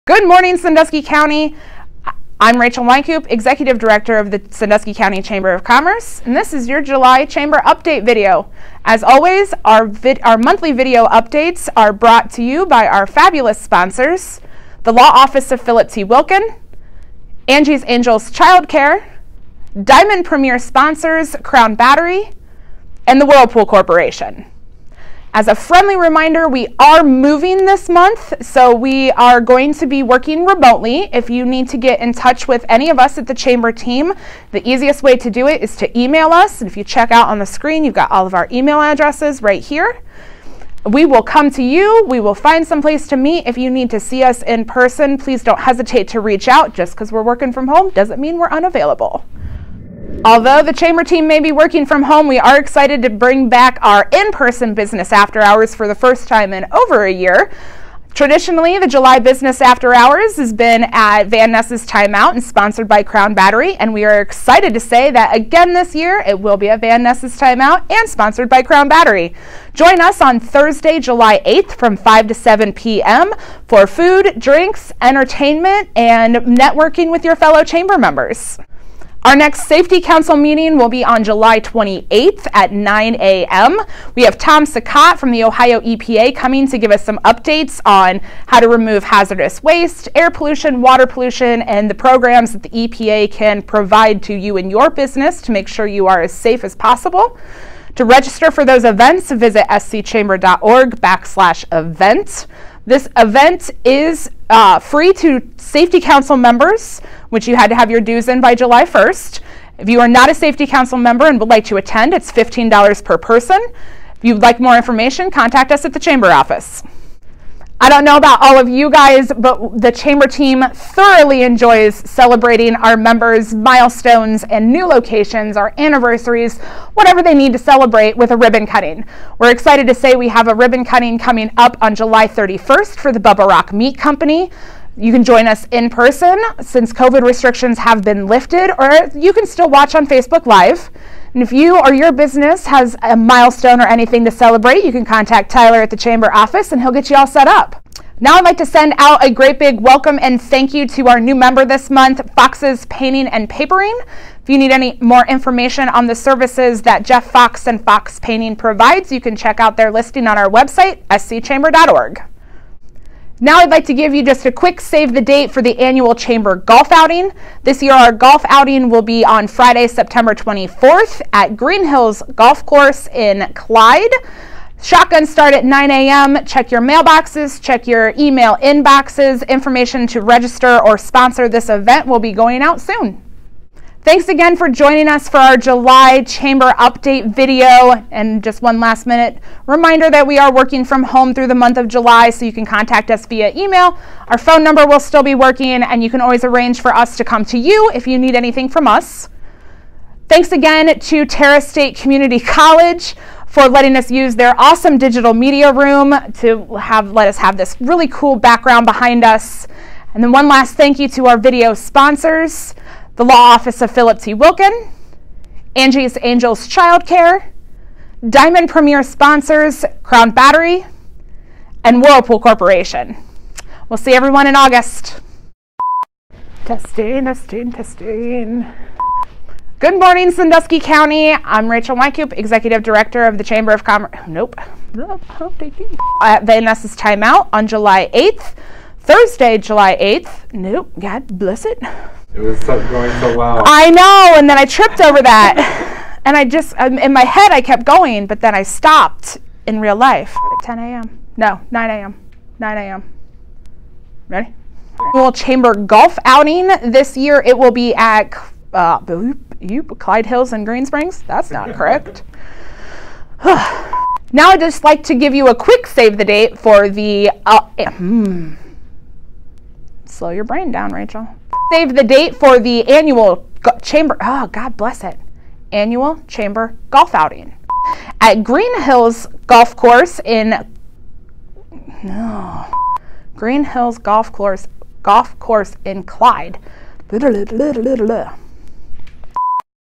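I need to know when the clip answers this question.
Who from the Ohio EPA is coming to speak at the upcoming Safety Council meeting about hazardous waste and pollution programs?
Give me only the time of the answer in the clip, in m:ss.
1:24.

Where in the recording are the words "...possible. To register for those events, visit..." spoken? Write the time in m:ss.
1:36.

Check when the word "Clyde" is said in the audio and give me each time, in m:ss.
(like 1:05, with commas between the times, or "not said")
2:53, 4:19, 4:46.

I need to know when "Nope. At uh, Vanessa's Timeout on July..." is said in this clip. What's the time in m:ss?
3:54.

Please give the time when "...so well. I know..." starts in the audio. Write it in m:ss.
4:03.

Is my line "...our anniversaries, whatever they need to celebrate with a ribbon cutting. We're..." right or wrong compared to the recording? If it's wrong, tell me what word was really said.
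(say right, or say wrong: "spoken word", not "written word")
right.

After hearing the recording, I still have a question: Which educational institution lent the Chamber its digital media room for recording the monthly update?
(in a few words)
Terra State Community College.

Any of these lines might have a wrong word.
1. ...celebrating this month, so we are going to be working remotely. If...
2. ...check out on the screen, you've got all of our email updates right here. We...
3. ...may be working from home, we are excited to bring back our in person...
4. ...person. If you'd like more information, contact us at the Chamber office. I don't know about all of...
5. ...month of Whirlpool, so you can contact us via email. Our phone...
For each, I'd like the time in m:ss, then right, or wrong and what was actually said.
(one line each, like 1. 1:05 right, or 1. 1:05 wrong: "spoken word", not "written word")
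1. 0:27 wrong: "moving", not "celebrating"
2. 0:36 wrong: "addresses", not "updates"
3. 0:51 right
4. 1:53 right
5. 3:11 wrong: "July", not "Whirlpool".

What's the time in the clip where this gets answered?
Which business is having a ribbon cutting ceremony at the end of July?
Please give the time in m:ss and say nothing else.
2:13.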